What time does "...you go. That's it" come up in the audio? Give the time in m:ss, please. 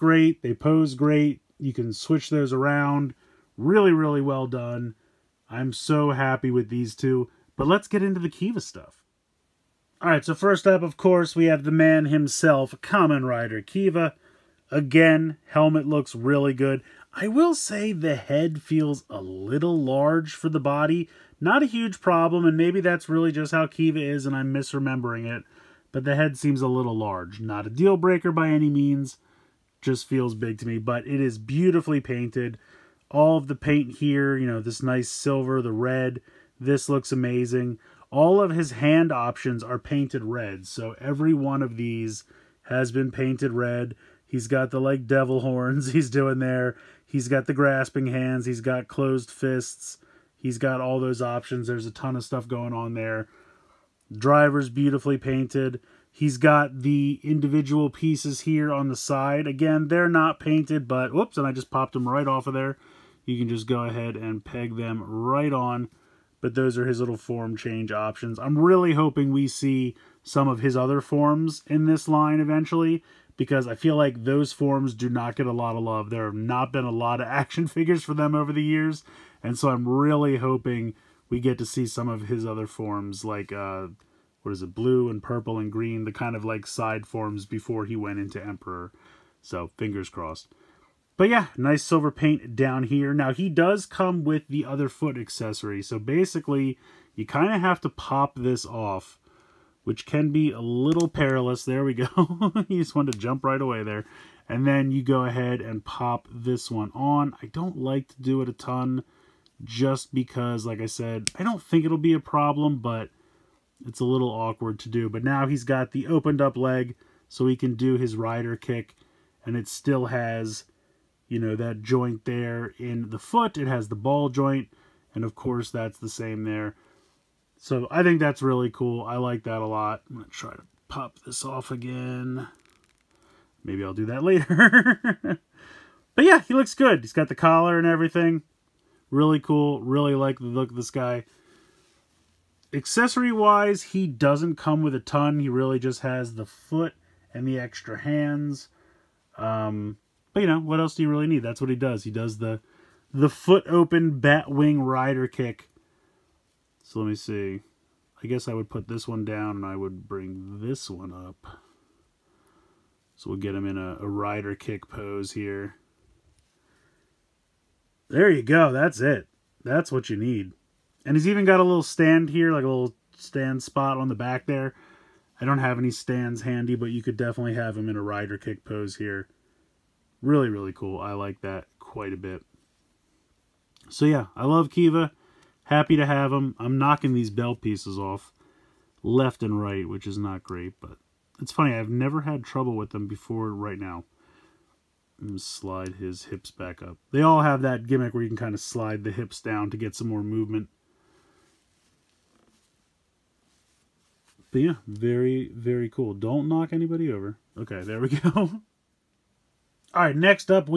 2:48.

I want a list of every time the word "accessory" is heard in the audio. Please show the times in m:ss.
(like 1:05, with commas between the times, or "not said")
1:35, 2:22.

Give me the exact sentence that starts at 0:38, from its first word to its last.
All of his hand options are painted red.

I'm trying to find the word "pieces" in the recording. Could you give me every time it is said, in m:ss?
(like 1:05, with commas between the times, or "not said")
0:57, 3:07.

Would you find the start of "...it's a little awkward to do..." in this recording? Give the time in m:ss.
1:53.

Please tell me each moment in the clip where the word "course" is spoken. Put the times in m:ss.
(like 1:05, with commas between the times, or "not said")
0:10, 2:05.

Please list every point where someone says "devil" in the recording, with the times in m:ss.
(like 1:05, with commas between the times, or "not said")
0:45.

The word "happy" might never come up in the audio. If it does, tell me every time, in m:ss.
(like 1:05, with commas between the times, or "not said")
0:06, 3:05.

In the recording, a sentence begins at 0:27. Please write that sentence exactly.
Not a deal breaker by any means, just feels big to me.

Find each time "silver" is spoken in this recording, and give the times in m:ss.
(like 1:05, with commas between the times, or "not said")
0:35, 1:31.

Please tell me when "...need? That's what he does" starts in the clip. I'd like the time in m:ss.
2:31.